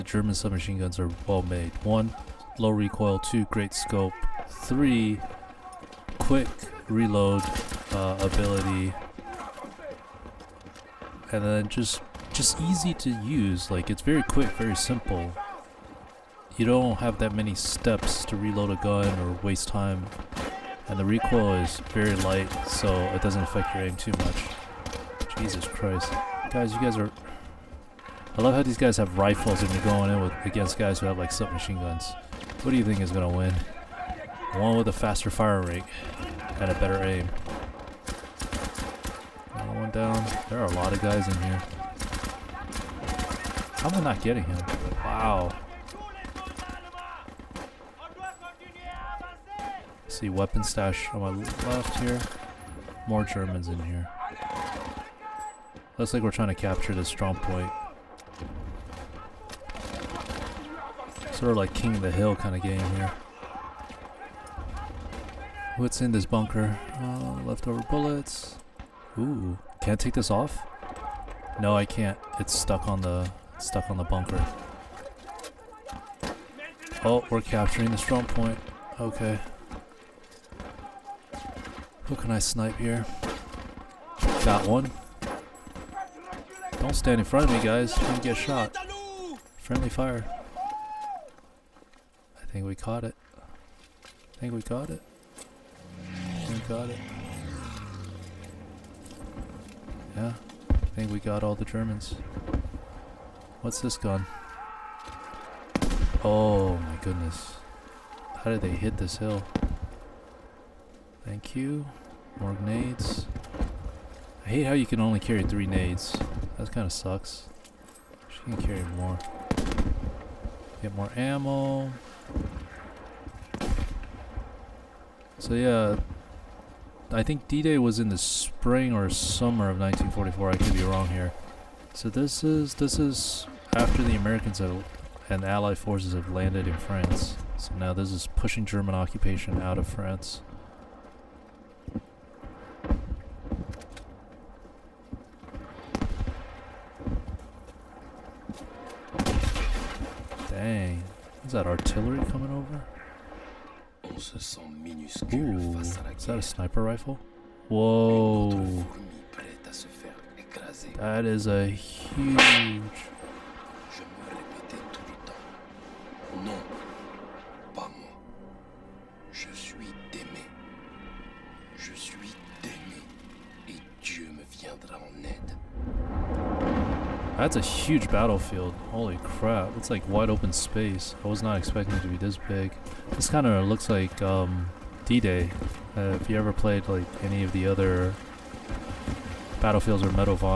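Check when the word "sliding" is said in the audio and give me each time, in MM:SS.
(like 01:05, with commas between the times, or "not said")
not said.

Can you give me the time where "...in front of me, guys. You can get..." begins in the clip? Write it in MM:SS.
01:27.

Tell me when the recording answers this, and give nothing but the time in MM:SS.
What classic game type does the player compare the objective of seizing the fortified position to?
01:01.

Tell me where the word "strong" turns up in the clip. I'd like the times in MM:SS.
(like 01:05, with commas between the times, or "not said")
00:57, 01:17.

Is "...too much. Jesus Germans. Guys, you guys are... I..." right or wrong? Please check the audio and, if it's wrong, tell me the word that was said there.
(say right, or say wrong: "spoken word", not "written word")
wrong: "Christ", not "Germans".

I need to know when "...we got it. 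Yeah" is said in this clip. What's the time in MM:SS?
01:36.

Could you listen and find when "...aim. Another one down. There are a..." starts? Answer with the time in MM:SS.
00:37.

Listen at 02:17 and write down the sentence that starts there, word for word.
So now this is pushing German occupation out of France.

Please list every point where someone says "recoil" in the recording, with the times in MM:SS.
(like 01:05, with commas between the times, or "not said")
00:02, 00:21.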